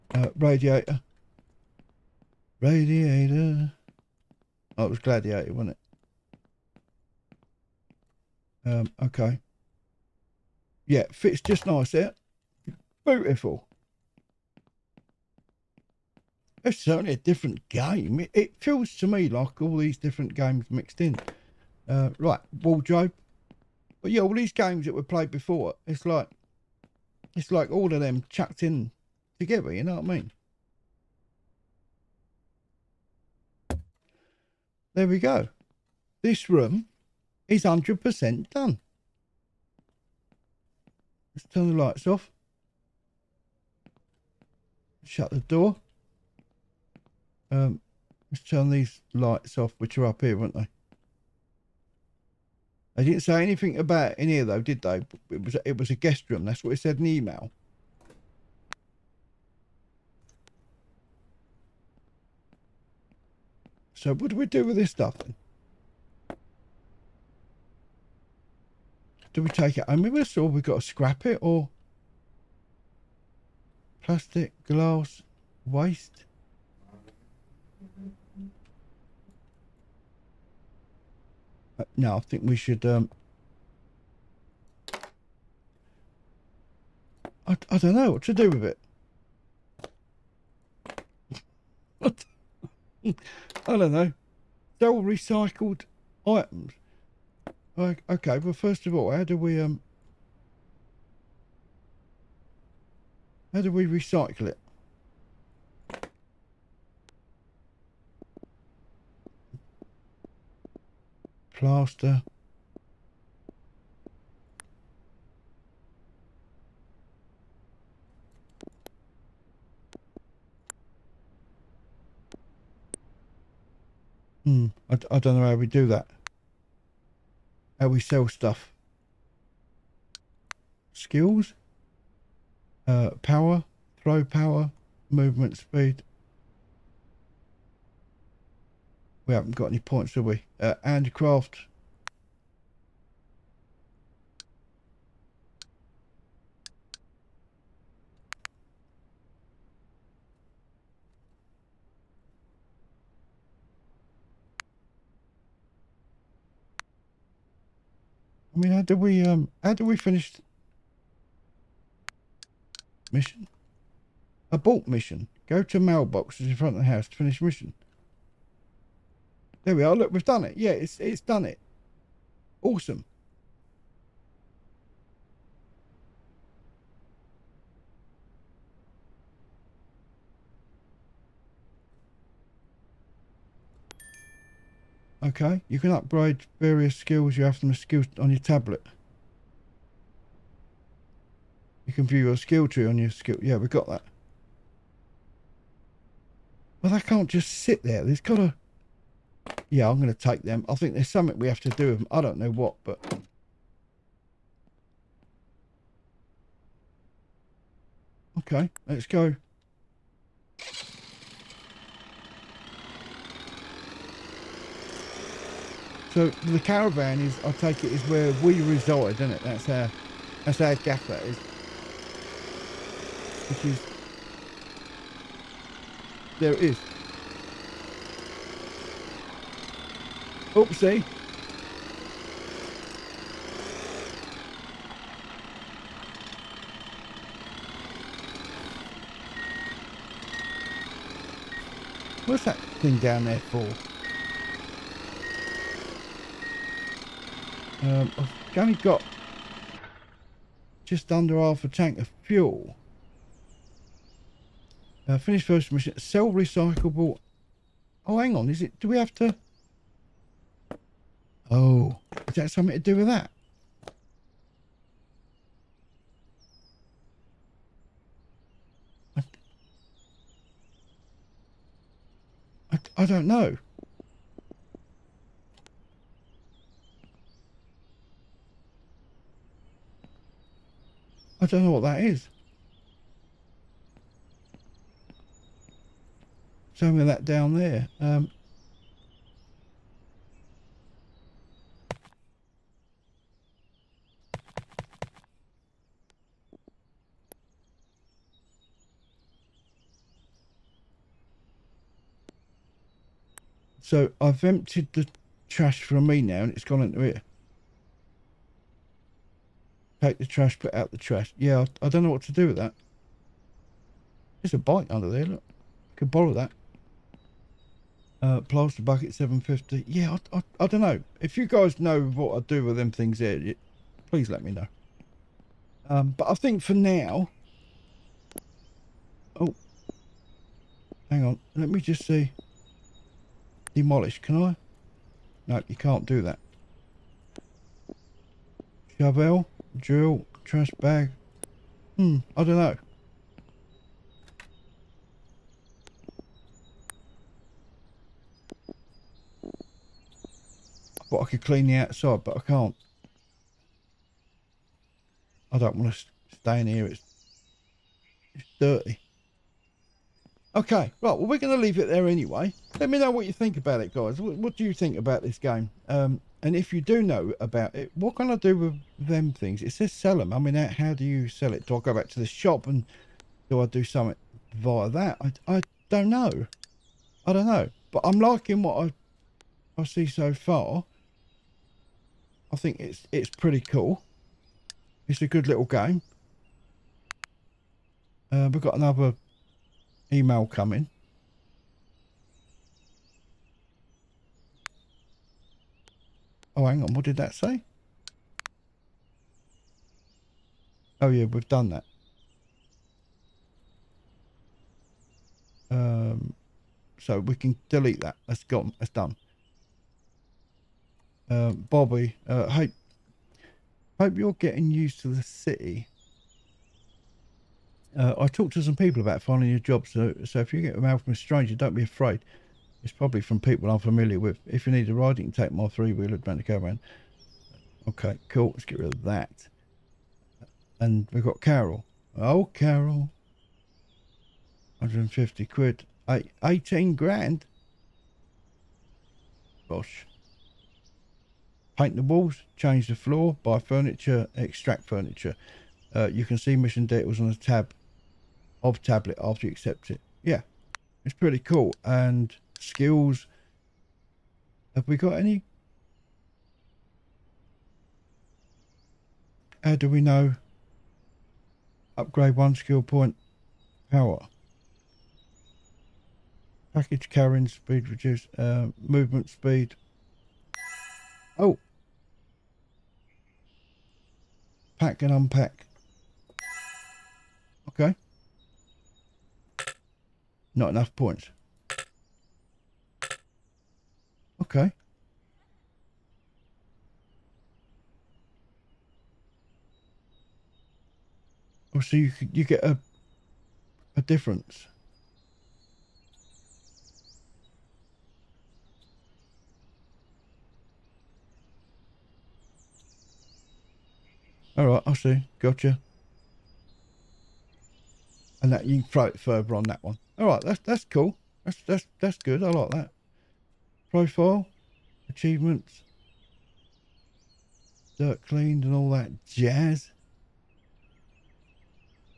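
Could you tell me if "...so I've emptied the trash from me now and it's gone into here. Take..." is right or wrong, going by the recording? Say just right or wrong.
right.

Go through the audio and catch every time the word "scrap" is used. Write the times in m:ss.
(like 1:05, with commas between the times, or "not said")
1:10.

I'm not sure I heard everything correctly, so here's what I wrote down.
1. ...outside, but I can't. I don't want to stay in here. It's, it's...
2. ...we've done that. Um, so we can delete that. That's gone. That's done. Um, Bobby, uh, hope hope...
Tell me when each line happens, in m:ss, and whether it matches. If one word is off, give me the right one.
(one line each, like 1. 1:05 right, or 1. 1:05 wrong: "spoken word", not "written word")
1. 5:51 right
2. 6:41 right.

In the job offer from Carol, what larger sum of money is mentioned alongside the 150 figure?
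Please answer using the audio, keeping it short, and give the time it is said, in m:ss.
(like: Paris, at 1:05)
18 grand, at 7:16.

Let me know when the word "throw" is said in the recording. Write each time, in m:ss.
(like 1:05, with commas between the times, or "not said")
2:14, 8:28.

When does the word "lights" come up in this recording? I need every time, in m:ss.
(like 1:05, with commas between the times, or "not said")
0:41, 0:49.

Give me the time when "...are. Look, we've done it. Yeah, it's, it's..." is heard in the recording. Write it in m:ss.
2:49.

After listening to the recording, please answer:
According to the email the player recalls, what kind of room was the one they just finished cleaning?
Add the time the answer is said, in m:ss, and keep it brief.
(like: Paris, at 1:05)
guest room, at 0:55.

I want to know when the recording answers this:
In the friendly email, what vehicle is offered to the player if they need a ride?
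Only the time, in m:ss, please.
7:05.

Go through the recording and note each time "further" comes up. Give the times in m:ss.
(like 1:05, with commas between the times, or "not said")
8:29.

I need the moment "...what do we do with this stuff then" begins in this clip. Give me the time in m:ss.
1:04.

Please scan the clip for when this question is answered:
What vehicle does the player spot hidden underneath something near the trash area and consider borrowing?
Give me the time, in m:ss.
5:14.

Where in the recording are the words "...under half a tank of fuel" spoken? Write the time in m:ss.
4:11.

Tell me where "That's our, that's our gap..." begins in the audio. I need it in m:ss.
3:39.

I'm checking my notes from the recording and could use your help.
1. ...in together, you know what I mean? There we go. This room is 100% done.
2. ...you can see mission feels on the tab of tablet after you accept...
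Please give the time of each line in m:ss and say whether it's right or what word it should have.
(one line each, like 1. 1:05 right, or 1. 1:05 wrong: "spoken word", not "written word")
1. 0:28 right
2. 7:26 wrong: "details", not "feels".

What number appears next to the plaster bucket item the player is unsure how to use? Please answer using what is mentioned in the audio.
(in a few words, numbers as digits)
750.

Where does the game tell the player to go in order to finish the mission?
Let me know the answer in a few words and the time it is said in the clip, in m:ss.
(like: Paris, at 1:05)
mailboxes in front of the house, at 2:45.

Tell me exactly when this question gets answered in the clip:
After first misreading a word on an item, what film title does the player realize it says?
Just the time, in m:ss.
0:04.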